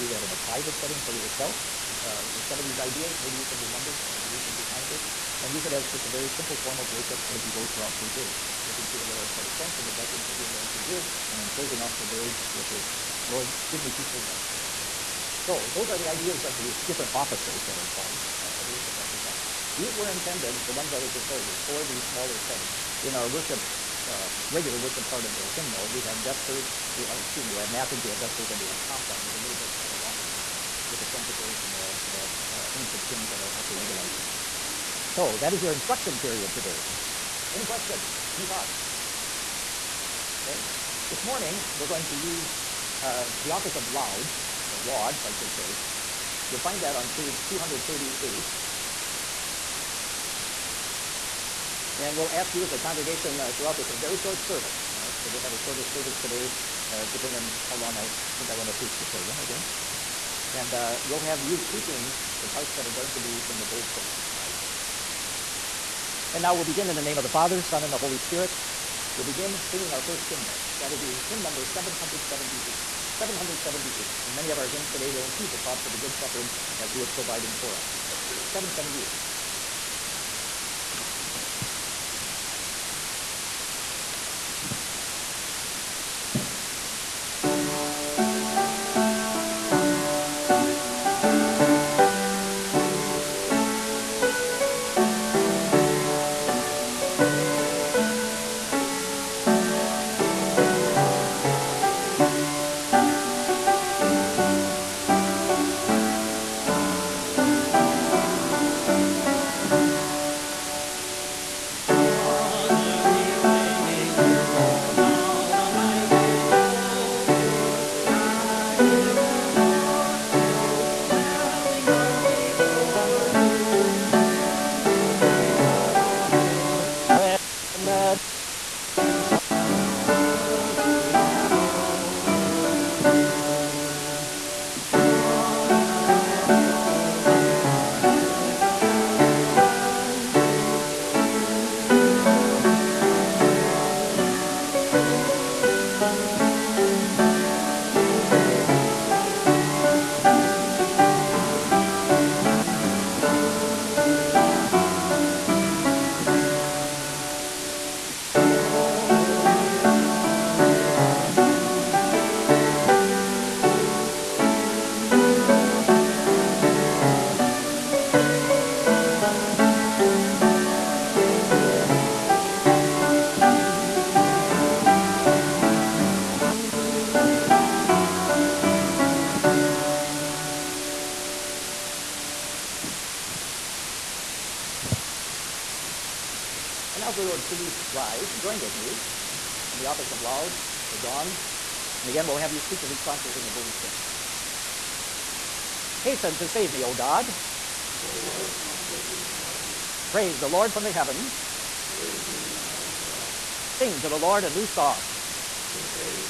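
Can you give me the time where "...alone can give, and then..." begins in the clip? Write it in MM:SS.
00:10.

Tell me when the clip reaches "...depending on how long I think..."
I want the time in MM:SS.
00:57.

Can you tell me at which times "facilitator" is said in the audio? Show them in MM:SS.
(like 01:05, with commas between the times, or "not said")
not said.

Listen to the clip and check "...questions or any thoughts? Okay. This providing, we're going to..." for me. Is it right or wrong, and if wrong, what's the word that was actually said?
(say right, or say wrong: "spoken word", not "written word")
wrong: "morning", not "providing".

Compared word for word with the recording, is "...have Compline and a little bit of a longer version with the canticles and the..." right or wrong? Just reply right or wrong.
right.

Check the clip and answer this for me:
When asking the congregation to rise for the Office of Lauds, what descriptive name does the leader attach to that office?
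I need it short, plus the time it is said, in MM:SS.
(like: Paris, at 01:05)
The Dawn, at 03:10.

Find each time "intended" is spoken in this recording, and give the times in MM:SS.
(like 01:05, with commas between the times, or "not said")
00:20.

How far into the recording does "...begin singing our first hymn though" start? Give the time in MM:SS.
01:09.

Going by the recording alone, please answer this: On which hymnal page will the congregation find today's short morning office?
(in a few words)
238.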